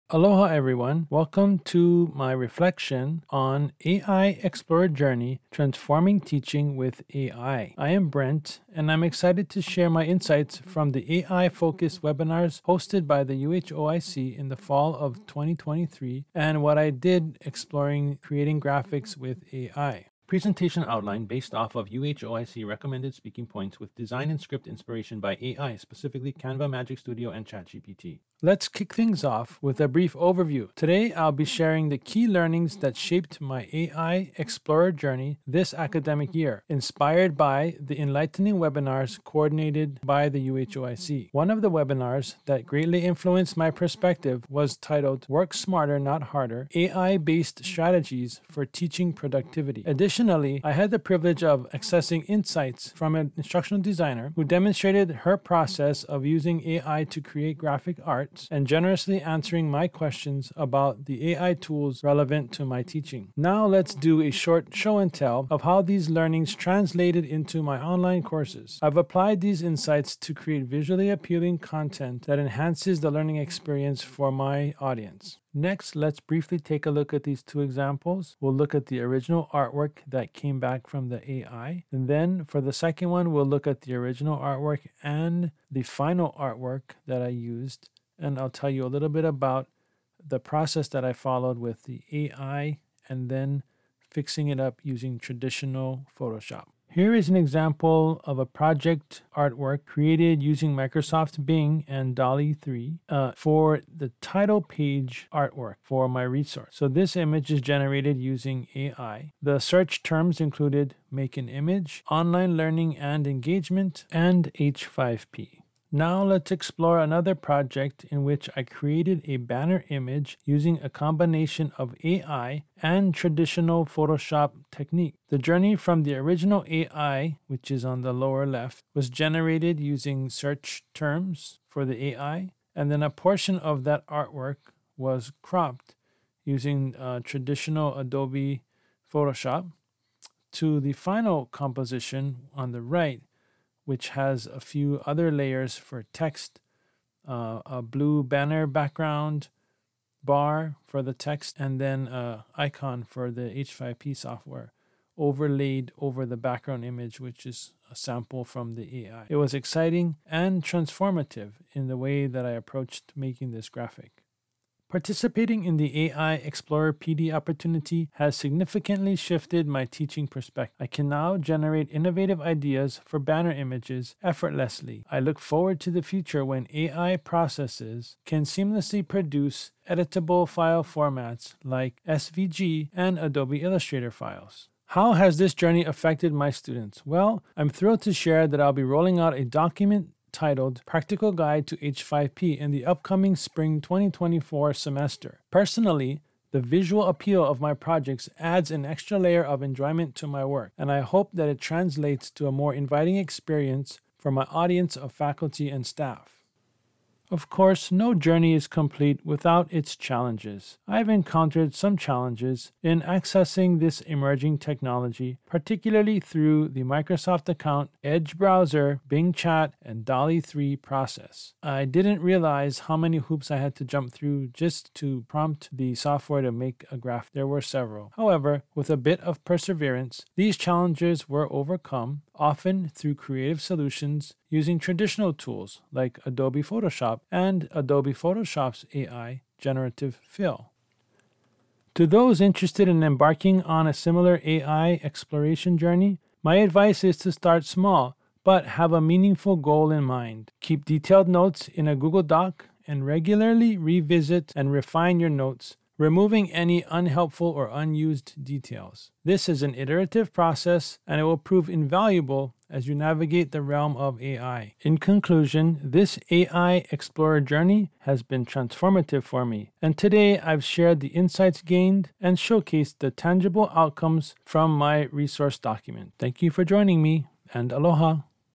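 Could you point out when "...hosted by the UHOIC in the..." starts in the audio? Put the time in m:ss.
0:12.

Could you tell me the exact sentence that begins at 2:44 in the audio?
Participating in the AI Explorer PD opportunity has significantly shifted my teaching perspective.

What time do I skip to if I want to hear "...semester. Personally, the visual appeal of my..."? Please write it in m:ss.
3:14.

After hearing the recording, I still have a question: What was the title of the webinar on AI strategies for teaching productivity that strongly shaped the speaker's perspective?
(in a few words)
Work Smarter, Not Harder.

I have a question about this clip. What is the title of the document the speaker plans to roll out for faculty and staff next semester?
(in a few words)
Practical Guide to H5P.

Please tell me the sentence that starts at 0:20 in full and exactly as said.
Presentation outline based off of UHOIC recommended speaking points with design and script inspiration by AI, specifically Canva Magic Studio and ChatGPT.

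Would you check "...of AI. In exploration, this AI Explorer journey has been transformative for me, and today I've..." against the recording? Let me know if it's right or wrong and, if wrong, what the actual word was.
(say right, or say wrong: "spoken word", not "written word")
wrong: "conclusion", not "exploration".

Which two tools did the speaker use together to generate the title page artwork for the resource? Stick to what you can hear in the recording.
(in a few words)
Microsoft Bing and DALL-E 3.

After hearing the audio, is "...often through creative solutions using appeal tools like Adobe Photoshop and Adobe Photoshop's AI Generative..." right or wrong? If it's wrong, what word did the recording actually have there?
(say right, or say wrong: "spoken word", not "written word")
wrong: "traditional", not "appeal".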